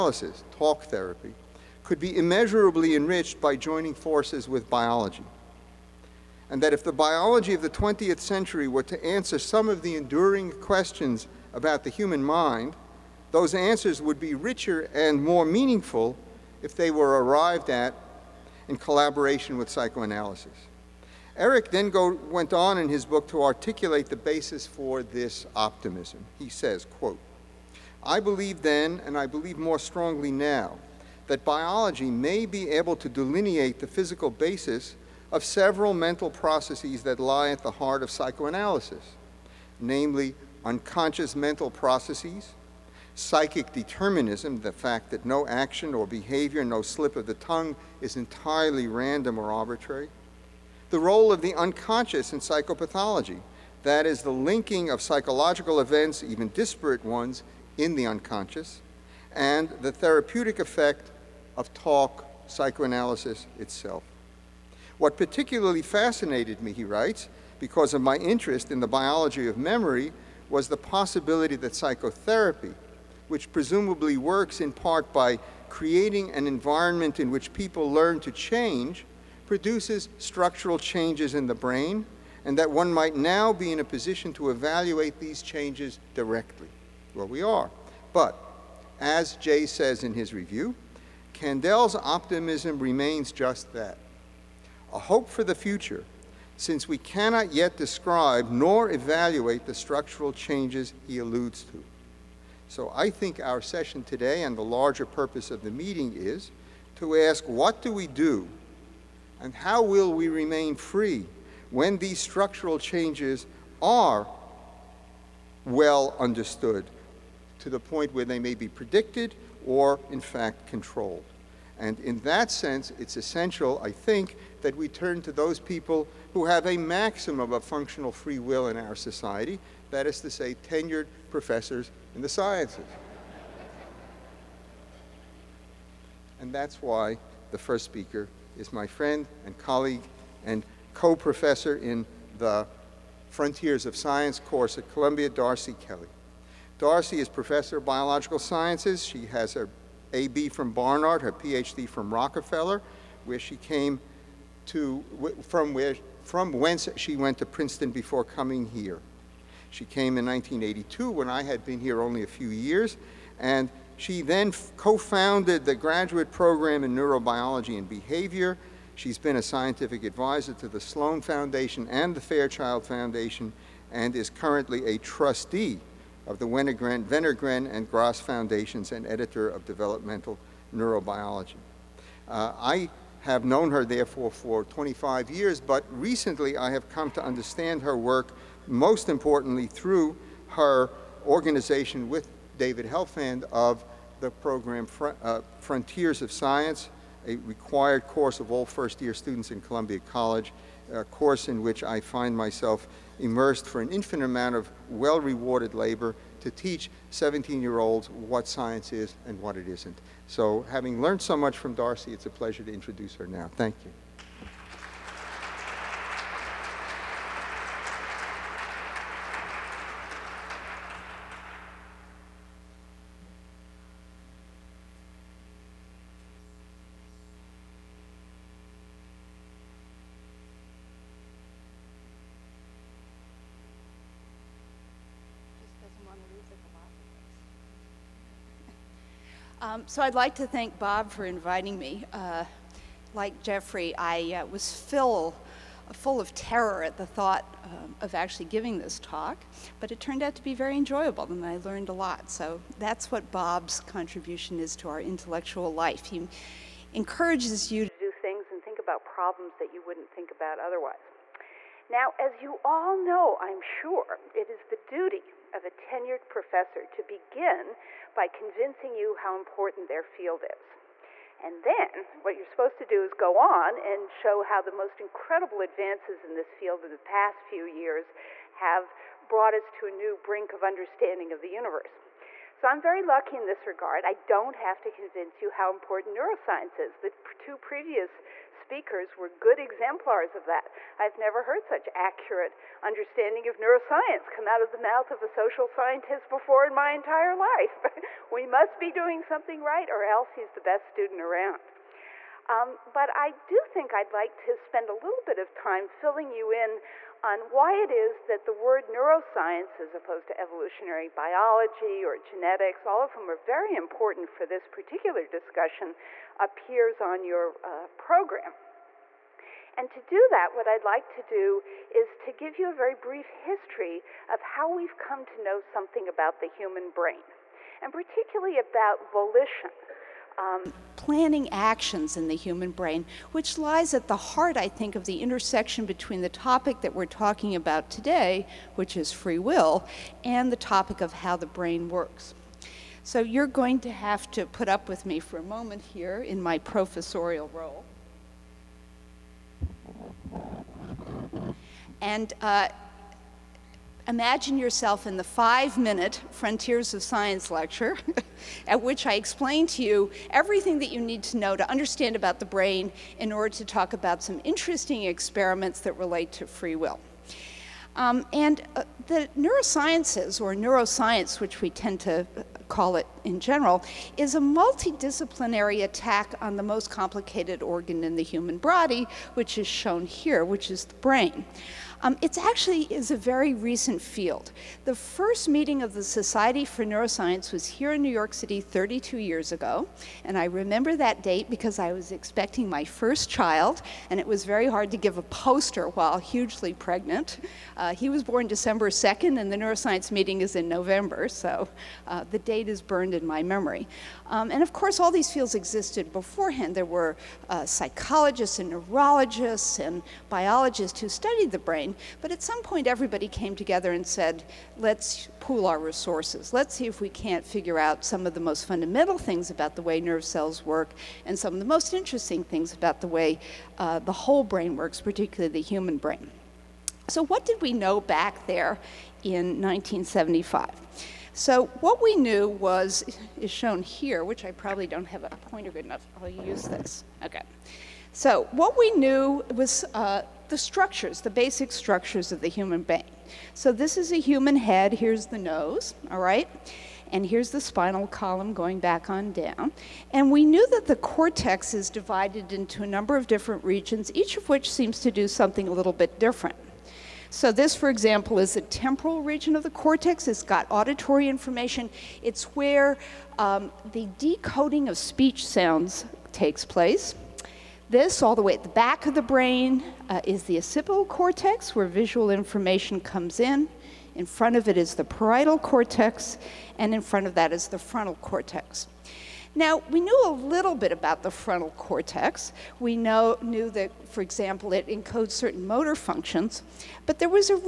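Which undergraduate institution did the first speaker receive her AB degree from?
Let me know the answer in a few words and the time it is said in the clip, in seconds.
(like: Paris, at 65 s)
Barnard, at 150 s.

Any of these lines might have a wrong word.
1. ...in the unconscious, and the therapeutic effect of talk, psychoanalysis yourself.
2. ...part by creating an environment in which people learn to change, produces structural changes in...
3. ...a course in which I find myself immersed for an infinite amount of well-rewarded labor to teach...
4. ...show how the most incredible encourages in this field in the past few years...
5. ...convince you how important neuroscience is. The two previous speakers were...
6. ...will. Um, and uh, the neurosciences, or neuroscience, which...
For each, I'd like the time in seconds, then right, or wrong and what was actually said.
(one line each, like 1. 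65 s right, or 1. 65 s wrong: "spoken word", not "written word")
1. 57 s wrong: "itself", not "yourself"
2. 74 s right
3. 200 s right
4. 274 s wrong: "advances", not "encourages"
5. 284 s right
6. 366 s right.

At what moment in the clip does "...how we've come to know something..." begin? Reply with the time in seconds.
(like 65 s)
324 s.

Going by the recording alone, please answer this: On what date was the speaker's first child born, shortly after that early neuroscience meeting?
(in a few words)
December 2nd.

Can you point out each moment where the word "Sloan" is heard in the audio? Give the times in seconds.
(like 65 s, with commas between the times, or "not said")
170 s.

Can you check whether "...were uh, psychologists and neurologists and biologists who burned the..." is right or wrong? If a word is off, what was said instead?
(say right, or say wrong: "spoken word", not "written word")
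wrong: "studied", not "burned".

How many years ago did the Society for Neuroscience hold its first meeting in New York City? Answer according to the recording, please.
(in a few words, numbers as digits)
32.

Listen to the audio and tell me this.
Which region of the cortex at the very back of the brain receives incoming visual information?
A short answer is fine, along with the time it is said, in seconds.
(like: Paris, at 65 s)
Occipital cortex, at 470 s.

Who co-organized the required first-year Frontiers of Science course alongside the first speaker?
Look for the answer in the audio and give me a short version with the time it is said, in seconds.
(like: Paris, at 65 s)
David Helfand, at 192 s.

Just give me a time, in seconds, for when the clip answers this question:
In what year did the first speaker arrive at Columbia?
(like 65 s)
160 s.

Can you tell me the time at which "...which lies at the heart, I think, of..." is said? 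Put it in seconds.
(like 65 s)
333 s.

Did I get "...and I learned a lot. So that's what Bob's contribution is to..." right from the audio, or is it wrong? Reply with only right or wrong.
right.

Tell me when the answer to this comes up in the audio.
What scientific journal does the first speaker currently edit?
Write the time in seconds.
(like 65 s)
179 s.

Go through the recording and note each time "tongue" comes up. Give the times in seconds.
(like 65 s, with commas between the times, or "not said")
47 s.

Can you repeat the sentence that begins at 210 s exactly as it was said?
So having learned so much from Darcy, it's a pleasure to introduce her now.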